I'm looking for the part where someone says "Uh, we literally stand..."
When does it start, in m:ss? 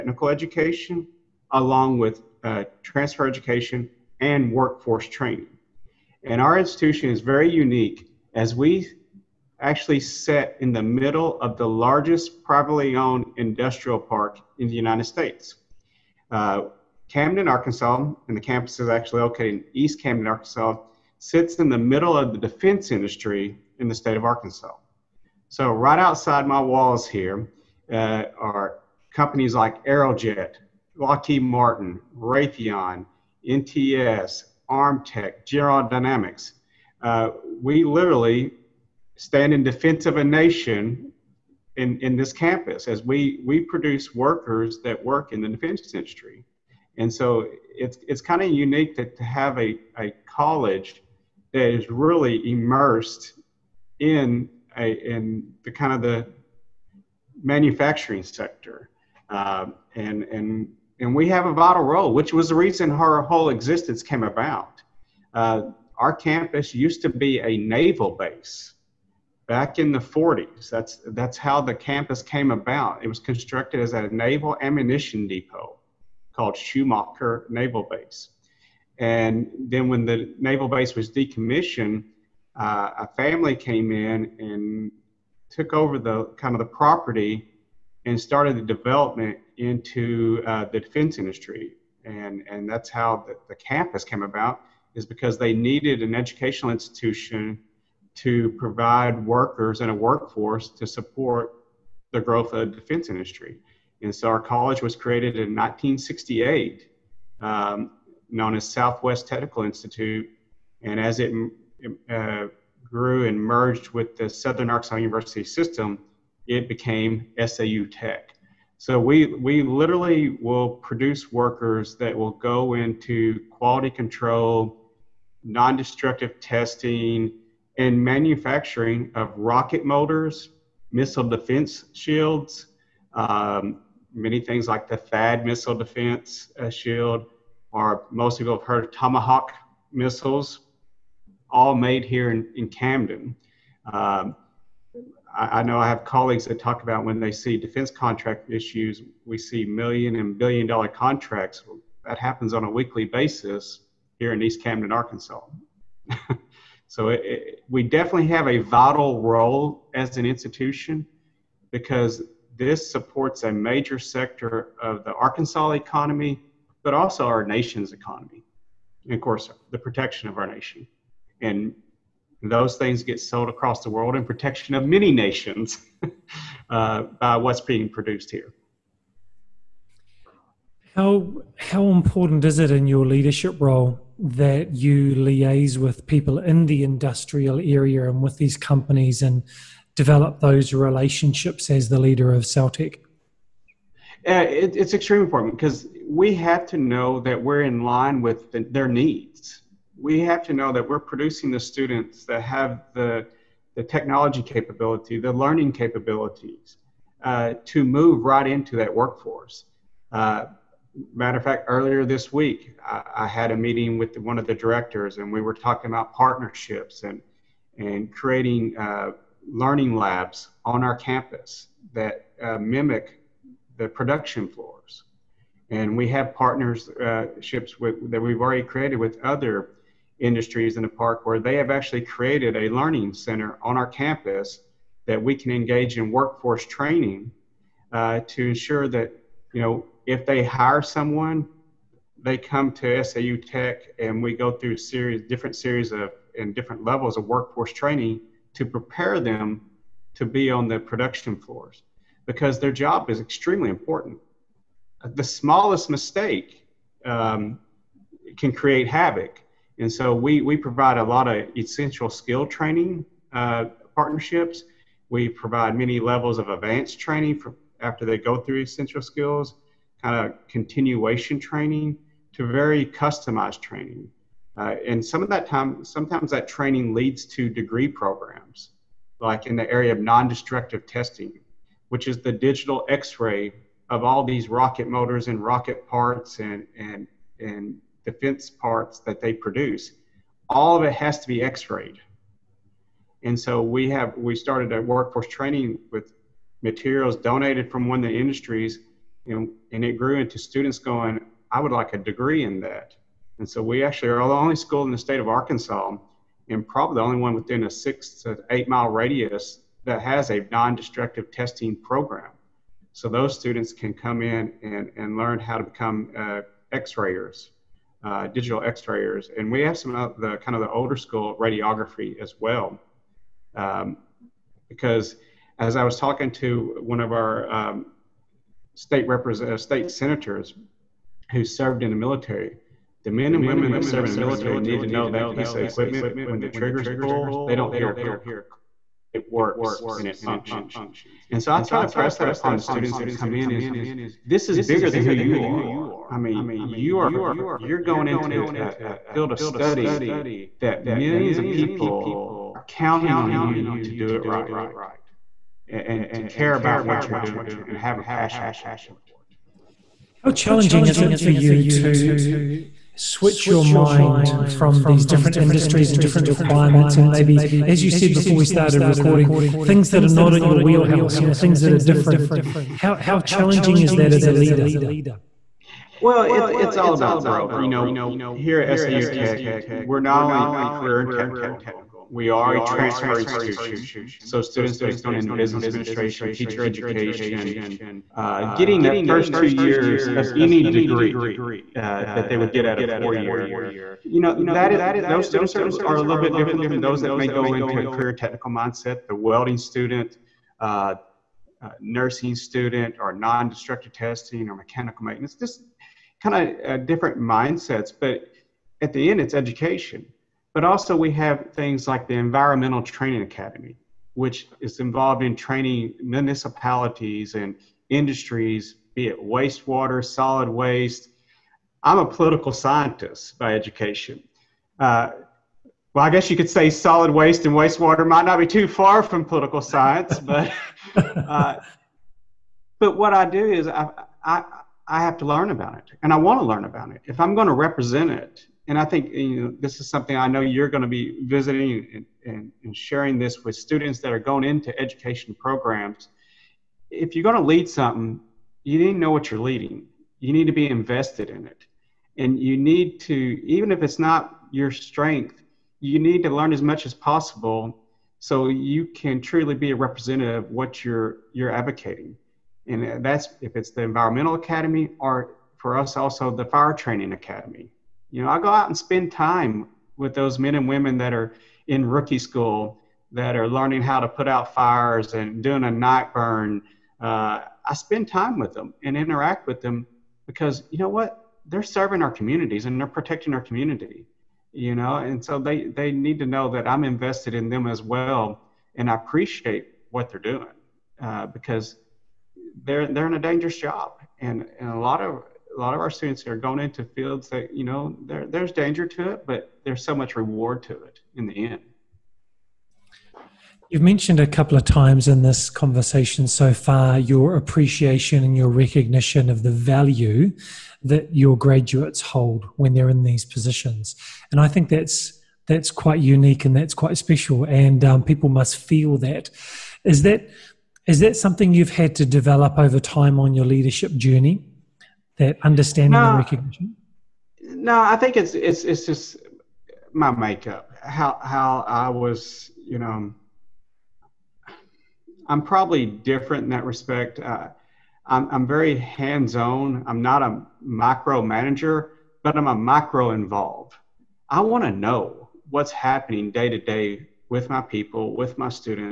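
0:37.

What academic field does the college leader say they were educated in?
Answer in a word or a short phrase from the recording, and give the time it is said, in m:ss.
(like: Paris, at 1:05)
Political science, at 7:02.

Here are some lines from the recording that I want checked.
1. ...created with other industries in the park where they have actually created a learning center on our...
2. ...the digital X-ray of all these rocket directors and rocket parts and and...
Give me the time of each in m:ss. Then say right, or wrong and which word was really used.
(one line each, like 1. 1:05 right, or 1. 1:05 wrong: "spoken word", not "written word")
1. 3:48 right
2. 4:42 wrong: "motors", not "directors".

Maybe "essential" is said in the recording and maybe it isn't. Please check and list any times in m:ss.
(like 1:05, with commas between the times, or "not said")
4:21, 4:28.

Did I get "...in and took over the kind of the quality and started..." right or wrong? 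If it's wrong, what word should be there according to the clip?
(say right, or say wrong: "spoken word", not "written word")
wrong: "property", not "quality".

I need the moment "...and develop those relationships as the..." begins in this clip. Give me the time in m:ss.
3:09.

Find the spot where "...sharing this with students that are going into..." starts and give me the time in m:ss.
7:22.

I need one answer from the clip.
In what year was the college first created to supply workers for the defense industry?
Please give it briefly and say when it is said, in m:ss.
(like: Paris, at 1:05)
1968, at 1:45.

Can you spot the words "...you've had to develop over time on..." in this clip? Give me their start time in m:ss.
8:41.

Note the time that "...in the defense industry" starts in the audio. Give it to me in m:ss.
0:45.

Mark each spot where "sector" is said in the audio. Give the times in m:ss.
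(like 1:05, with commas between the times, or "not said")
0:58, 2:43.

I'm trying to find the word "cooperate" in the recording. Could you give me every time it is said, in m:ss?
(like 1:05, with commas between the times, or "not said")
not said.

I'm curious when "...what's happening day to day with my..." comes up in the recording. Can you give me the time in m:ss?
9:05.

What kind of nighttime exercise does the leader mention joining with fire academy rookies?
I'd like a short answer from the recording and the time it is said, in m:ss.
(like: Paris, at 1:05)
A night burn, at 7:55.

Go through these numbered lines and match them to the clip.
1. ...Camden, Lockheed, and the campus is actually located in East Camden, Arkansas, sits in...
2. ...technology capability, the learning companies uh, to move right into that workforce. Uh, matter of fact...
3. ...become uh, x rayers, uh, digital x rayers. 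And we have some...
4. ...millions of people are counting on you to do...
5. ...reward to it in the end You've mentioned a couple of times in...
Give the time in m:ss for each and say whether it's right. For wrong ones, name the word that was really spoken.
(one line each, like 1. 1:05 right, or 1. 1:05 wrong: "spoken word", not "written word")
1. 0:17 wrong: "Arkansas", not "Lockheed"
2. 3:23 wrong: "capabilities", not "companies"
3. 5:15 right
4. 5:50 right
5. 8:20 right.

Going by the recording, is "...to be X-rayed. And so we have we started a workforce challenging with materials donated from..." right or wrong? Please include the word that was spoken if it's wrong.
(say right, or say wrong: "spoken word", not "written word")
wrong: "training", not "challenging".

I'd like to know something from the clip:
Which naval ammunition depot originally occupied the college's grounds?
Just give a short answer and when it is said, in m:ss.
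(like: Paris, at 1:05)
Shumaker Naval Base, at 1:16.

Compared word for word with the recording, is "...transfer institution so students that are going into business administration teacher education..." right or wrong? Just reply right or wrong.
right.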